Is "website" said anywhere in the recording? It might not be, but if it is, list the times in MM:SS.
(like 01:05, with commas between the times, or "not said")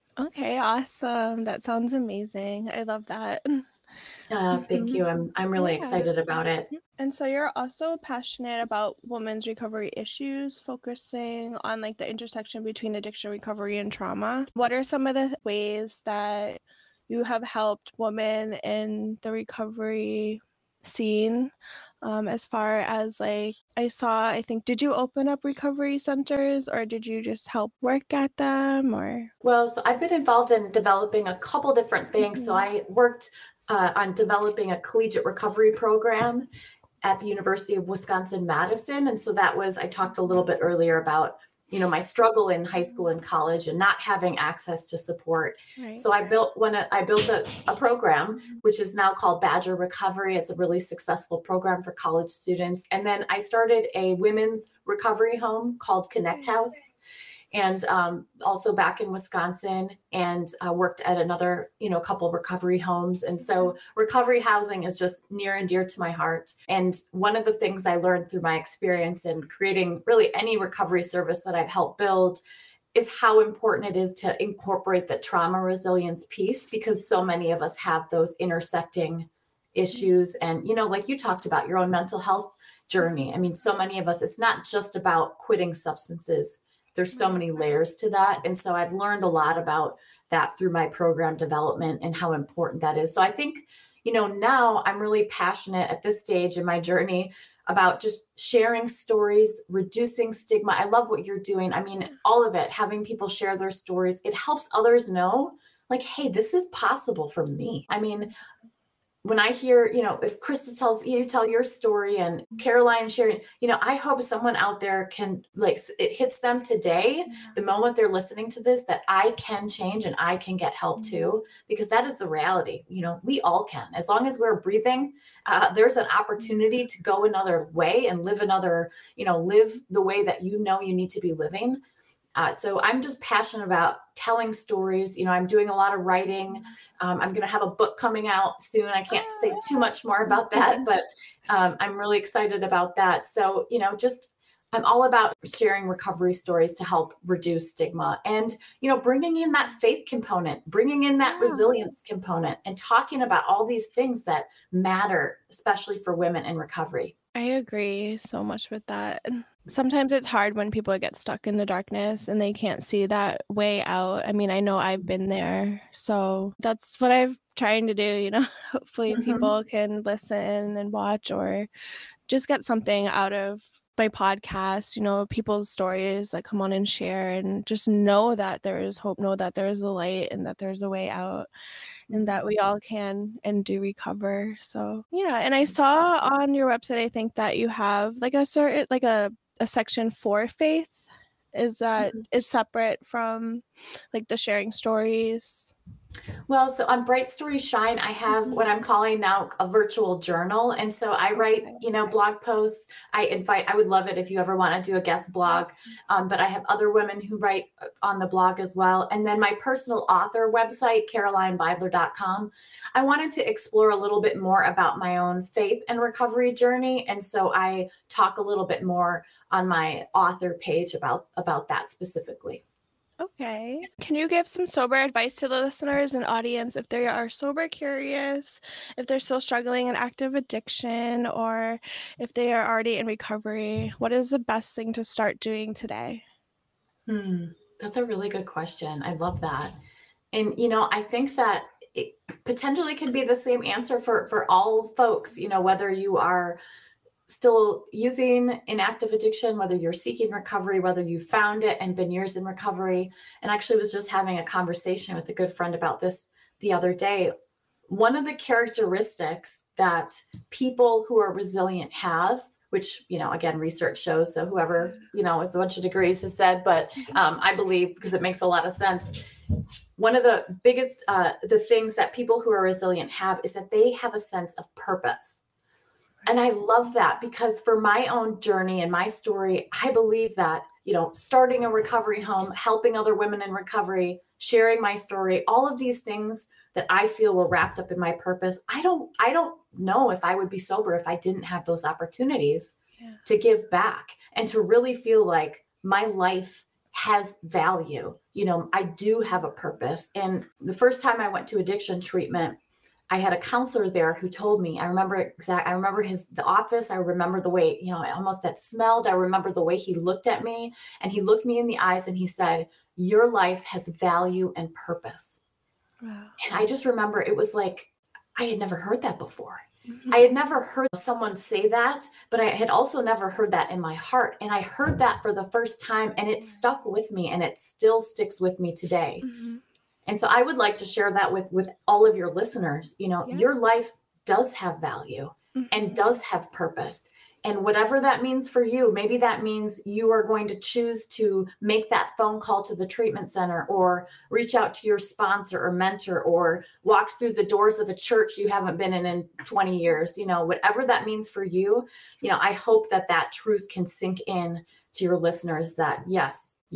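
03:06, 03:30.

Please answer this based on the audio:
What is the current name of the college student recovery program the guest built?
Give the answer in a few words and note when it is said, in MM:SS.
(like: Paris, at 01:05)
Badger Recovery, at 00:49.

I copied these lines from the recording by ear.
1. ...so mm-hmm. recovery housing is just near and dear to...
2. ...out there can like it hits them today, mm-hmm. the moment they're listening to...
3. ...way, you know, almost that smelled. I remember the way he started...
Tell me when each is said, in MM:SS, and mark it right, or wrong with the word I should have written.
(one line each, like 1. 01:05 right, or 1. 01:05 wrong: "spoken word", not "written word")
1. 01:03 right
2. 01:54 right
3. 05:07 wrong: "looked", not "started".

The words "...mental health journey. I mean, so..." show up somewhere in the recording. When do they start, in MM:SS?
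01:21.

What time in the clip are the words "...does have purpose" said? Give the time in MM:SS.
05:35.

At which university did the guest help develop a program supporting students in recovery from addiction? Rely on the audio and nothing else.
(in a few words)
University of Wisconsin Madison.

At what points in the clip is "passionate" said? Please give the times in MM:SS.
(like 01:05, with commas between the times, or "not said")
00:08, 01:35, 02:13.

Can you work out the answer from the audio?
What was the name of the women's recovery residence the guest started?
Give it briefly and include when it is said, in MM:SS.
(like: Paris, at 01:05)
Connect House, at 00:56.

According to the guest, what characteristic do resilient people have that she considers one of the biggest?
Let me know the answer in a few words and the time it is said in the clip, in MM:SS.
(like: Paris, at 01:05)
a sense of purpose, at 04:34.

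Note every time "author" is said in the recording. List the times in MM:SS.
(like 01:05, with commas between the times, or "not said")
03:30, 03:40.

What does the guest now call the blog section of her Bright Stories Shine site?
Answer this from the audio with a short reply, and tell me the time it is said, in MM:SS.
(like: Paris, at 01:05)
virtual journal, at 03:19.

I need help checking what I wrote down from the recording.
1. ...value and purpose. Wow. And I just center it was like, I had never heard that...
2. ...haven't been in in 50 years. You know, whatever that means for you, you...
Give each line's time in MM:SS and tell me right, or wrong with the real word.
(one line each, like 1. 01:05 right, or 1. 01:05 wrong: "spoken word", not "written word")
1. 05:13 wrong: "remember", not "center"
2. 05:48 wrong: "20", not "50".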